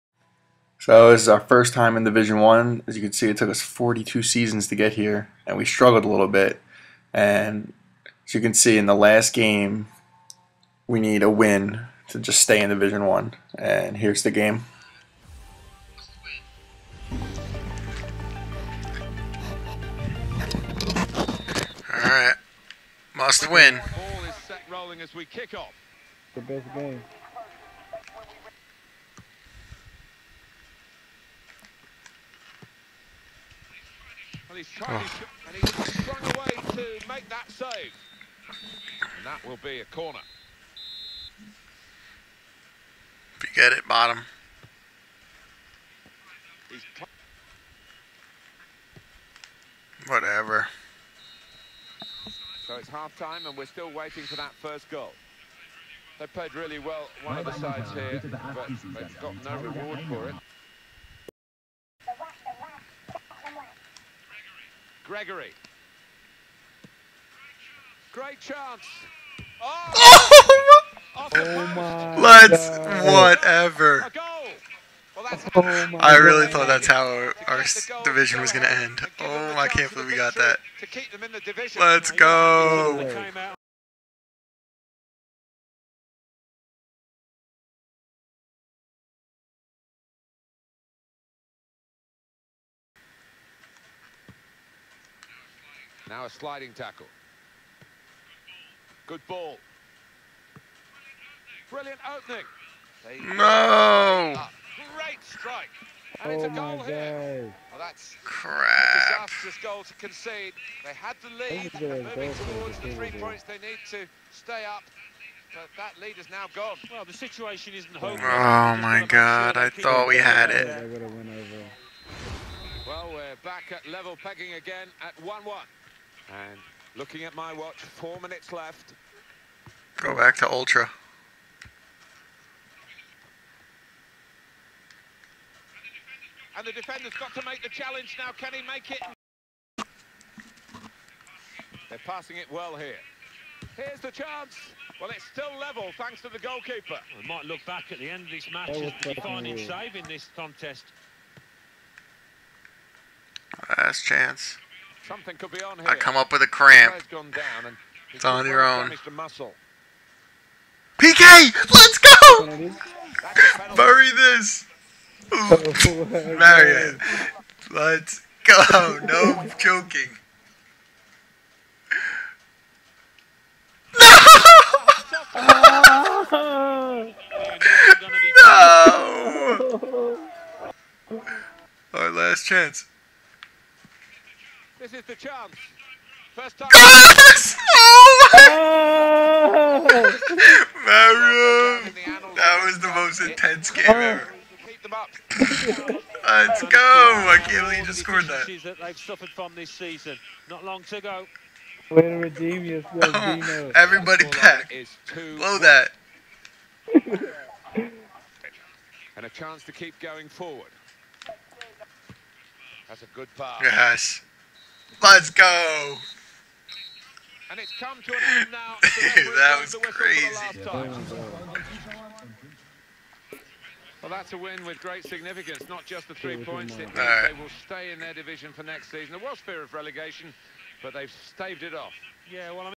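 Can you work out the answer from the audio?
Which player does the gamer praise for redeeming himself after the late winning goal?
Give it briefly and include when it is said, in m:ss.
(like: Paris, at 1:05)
Dino, at 3:23.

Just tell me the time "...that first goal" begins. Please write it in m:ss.
0:54.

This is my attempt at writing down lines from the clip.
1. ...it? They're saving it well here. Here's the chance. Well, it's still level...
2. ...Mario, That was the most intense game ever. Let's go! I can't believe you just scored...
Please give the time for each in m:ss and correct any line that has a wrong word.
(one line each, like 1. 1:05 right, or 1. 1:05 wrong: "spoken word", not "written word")
1. 2:18 wrong: "passing", not "saving"
2. 3:11 right.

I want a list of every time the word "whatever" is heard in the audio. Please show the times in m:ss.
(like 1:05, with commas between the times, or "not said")
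0:50, 1:13.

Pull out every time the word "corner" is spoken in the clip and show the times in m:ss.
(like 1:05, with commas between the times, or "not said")
0:39.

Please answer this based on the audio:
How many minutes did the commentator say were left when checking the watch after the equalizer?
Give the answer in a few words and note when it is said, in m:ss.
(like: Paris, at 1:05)
4, at 2:07.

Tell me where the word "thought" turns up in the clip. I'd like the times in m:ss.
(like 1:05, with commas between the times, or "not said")
1:16, 1:59.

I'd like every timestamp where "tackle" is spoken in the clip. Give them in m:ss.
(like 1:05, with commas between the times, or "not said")
1:36.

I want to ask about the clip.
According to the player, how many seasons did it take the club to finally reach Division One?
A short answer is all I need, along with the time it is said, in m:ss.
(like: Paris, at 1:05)
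42, at 0:03.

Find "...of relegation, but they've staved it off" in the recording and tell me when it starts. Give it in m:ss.
3:49.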